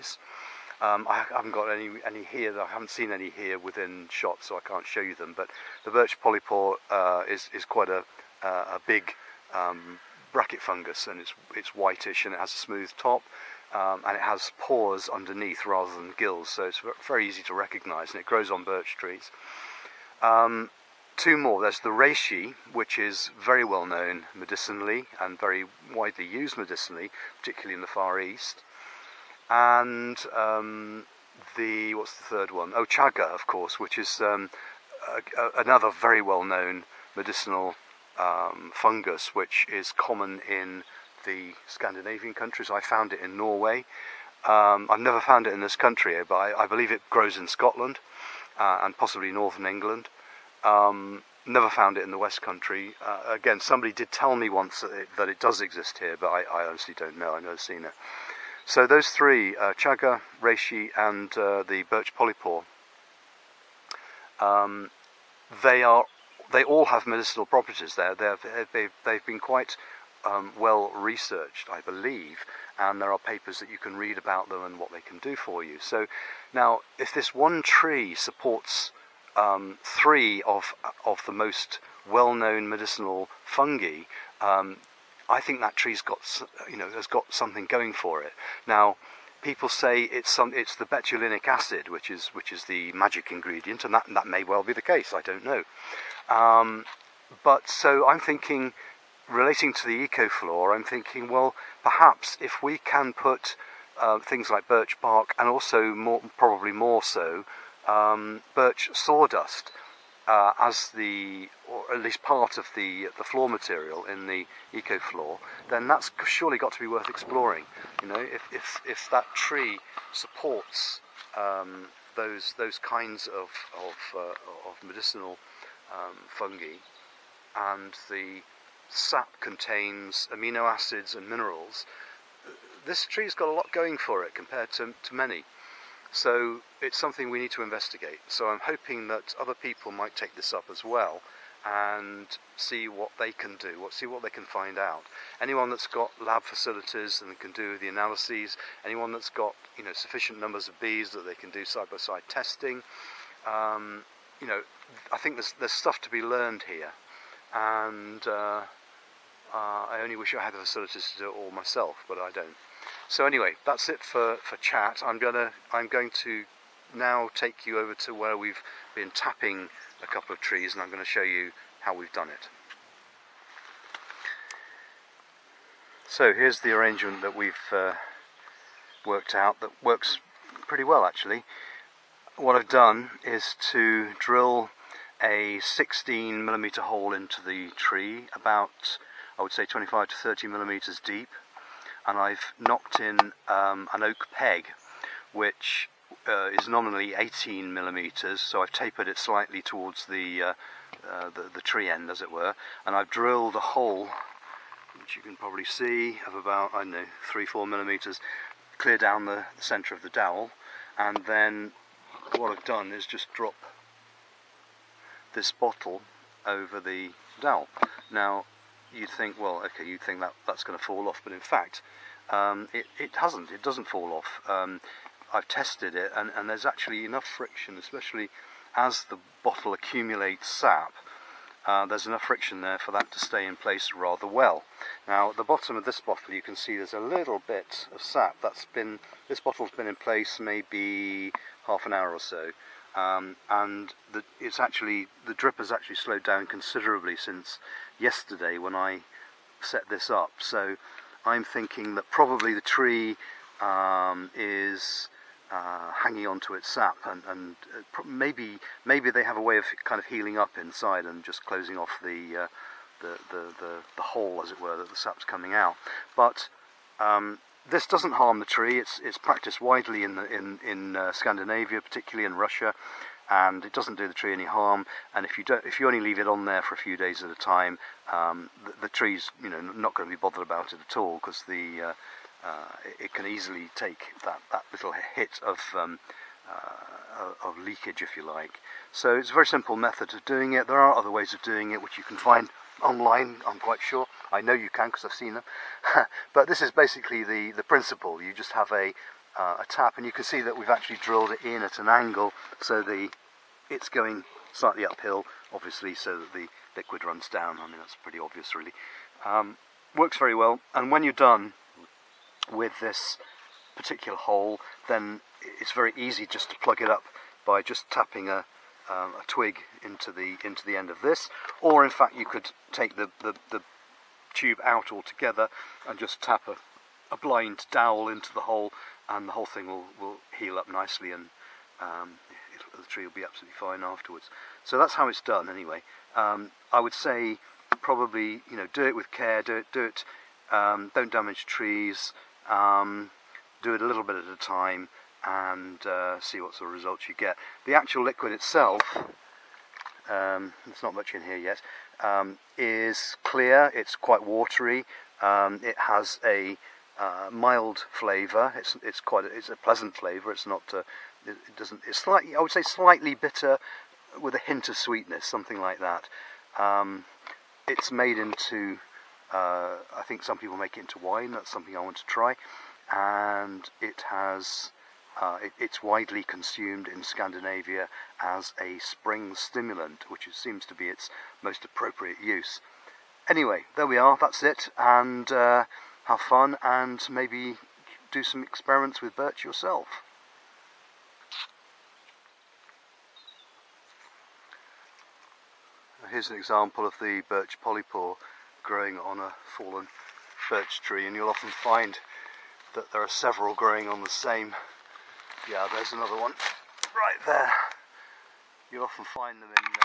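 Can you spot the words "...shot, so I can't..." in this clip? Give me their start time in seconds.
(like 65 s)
4 s.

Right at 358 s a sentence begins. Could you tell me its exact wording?
It's it's quite a, it's a pleasant flavour.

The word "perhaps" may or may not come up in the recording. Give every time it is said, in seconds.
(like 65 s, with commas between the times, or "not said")
101 s.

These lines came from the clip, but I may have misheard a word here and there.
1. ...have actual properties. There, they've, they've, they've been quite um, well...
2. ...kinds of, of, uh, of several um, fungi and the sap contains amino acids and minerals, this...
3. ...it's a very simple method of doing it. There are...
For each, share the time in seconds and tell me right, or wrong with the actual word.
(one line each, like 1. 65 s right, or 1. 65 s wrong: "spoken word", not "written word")
1. 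66 s wrong: "medicinal", not "actual"
2. 122 s wrong: "medicinal", not "several"
3. 289 s right.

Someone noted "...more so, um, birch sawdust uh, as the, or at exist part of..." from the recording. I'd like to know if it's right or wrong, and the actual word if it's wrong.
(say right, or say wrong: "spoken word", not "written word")
wrong: "least", not "exist".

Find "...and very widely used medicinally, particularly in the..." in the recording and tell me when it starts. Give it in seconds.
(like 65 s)
25 s.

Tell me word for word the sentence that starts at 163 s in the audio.
So anyway, that's it for, for chat.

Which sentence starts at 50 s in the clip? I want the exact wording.
Um, never found it in the West Country.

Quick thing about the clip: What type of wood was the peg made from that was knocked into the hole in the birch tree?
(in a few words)
oak.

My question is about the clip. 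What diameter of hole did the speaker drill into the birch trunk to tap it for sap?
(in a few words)
16 millimeters.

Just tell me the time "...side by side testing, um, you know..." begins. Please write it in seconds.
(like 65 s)
151 s.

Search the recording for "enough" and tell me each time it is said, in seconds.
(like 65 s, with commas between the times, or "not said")
227 s, 232 s.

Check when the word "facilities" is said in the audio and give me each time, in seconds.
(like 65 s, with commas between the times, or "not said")
146 s, 160 s.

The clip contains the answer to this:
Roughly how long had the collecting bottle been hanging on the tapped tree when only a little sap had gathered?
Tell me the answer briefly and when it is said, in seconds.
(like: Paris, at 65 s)
half an hour, at 241 s.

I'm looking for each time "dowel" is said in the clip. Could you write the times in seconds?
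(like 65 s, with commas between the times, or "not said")
210 s, 217 s, 327 s.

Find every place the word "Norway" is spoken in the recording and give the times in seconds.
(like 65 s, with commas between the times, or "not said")
43 s.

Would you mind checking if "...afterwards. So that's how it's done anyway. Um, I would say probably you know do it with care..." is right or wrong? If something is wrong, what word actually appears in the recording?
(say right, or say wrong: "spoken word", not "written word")
right.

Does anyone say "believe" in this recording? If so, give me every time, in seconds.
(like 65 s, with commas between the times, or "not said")
46 s, 71 s.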